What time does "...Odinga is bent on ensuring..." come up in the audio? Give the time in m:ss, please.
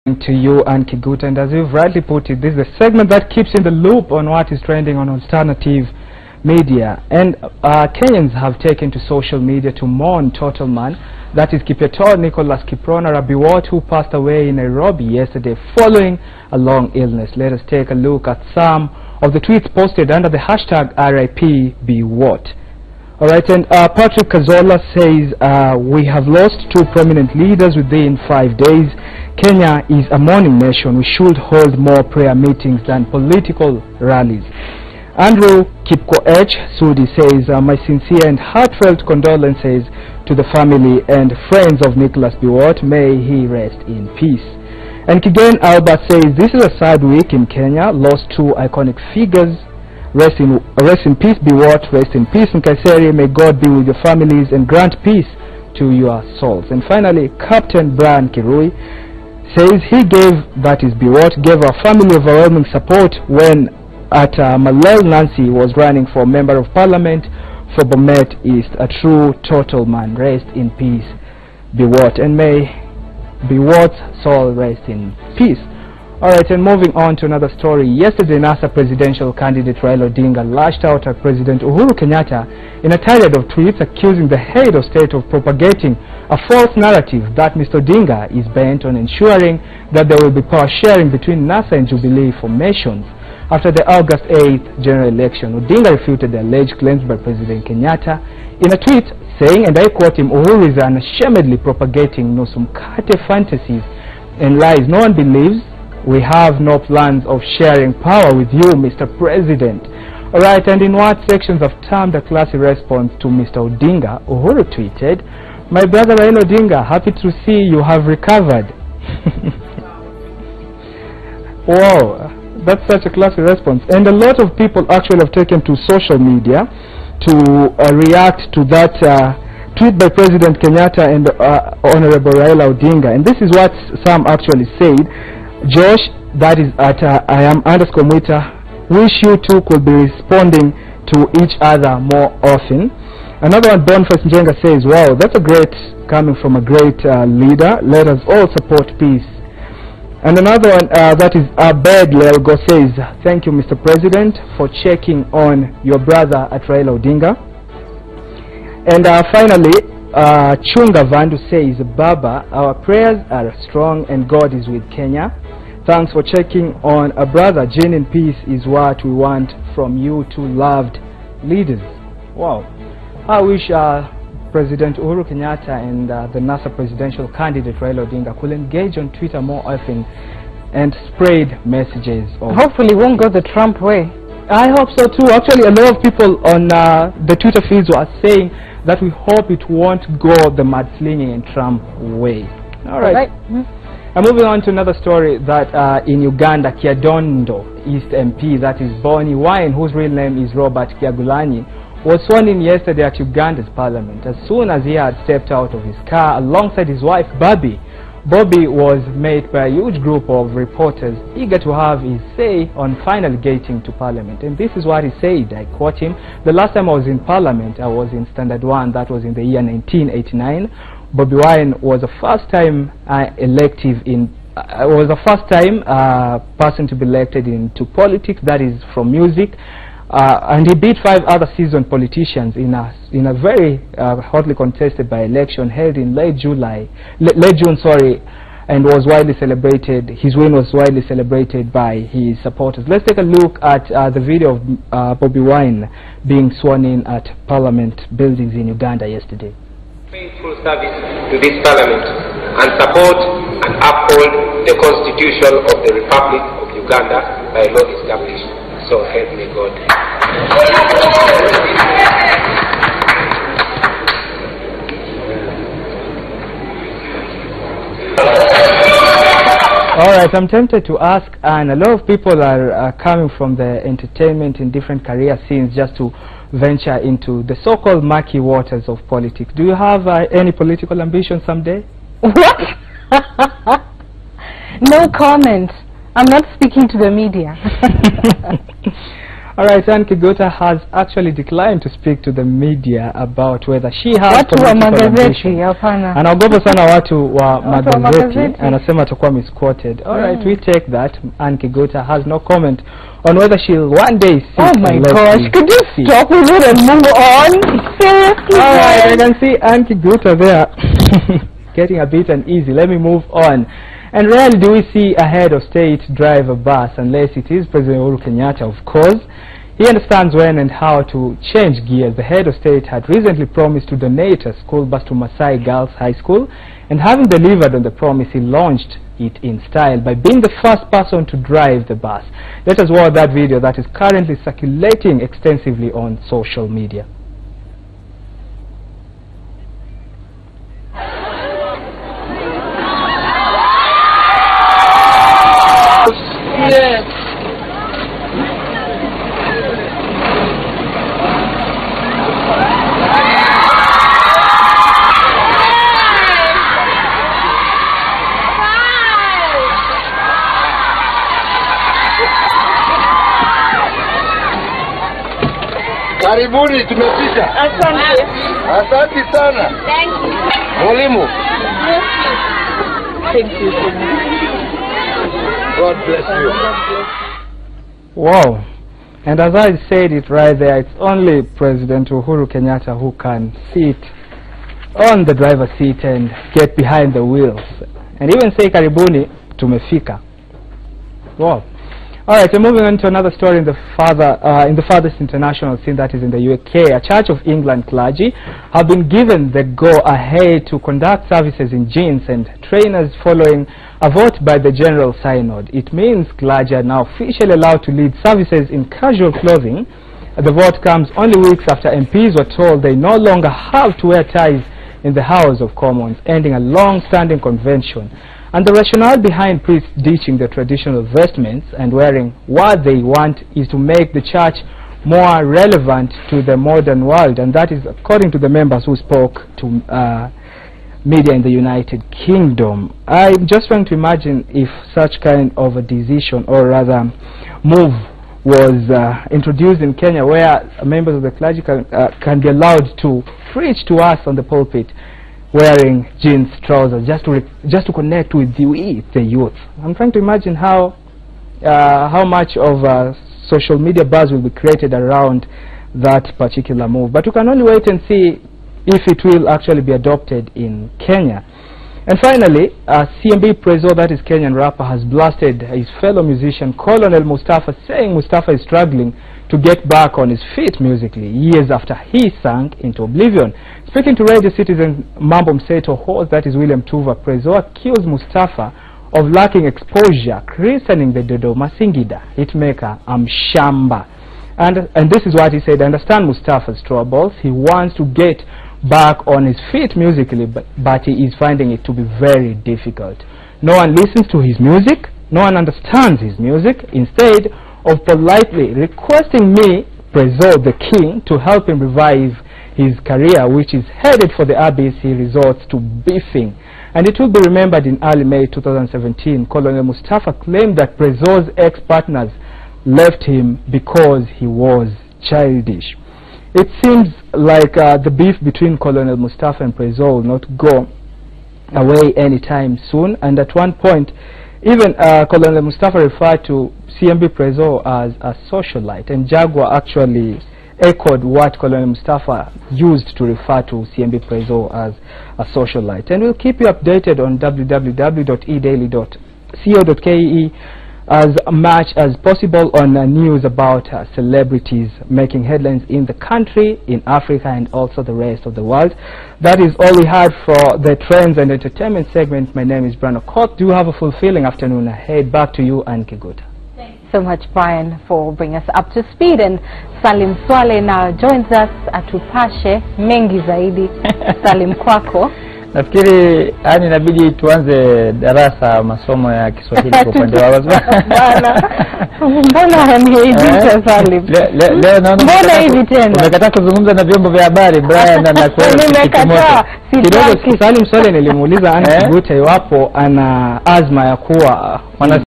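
1:27.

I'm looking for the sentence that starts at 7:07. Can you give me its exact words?
And that is according to the members who spoke to uh, media in the United Kingdom.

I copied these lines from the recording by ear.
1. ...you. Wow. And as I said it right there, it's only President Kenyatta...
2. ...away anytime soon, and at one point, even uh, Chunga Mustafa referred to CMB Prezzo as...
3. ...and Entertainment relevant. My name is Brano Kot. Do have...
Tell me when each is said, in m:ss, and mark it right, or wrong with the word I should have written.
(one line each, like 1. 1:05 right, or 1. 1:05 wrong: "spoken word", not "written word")
1. 6:16 wrong: "Uhuru", not "Kenyatta"
2. 8:41 wrong: "Colonel", not "Chunga"
3. 9:11 wrong: "segment", not "relevant".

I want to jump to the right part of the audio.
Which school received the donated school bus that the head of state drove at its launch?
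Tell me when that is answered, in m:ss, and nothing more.
5:25.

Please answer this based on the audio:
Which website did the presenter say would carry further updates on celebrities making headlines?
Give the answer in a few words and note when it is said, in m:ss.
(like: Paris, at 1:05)
www.edaily.co.ke, at 8:57.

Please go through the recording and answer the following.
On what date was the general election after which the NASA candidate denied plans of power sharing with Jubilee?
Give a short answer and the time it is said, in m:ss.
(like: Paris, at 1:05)
August 8th, at 1:33.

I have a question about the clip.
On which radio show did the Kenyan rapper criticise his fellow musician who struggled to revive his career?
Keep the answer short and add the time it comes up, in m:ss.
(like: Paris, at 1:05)
Mambo Mseto, at 7:55.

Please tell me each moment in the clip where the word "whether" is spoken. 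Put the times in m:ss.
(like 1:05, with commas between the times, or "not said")
4:53, 5:03.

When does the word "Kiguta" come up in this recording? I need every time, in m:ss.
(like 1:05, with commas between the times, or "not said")
0:00, 4:50, 5:01, 5:09, 9:16.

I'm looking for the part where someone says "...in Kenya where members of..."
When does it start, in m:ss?
7:19.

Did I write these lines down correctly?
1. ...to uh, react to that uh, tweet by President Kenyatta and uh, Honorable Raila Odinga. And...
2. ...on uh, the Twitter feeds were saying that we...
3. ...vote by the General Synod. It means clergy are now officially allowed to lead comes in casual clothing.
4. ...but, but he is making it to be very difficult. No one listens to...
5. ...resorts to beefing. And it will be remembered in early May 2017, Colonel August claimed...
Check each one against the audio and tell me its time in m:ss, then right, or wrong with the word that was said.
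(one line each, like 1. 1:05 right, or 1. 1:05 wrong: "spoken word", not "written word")
1. 2:07 right
2. 3:06 right
3. 6:44 wrong: "services", not "comes"
4. 8:10 wrong: "finding", not "making"
5. 8:25 wrong: "Mustafa", not "August".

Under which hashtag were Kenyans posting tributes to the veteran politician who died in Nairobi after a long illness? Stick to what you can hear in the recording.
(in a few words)
RIPBWAT.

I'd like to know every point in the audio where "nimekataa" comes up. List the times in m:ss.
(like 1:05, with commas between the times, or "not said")
9:38.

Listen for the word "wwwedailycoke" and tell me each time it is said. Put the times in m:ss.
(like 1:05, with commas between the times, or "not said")
8:57.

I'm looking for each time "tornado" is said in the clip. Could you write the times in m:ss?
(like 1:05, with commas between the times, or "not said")
not said.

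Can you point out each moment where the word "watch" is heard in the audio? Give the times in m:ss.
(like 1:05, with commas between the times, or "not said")
5:32.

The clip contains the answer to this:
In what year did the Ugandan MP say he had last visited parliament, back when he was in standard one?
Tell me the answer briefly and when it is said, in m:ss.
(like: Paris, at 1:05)
1989, at 3:39.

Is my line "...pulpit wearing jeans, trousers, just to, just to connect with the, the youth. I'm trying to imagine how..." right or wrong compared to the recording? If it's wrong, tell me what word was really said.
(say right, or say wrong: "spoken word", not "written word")
right.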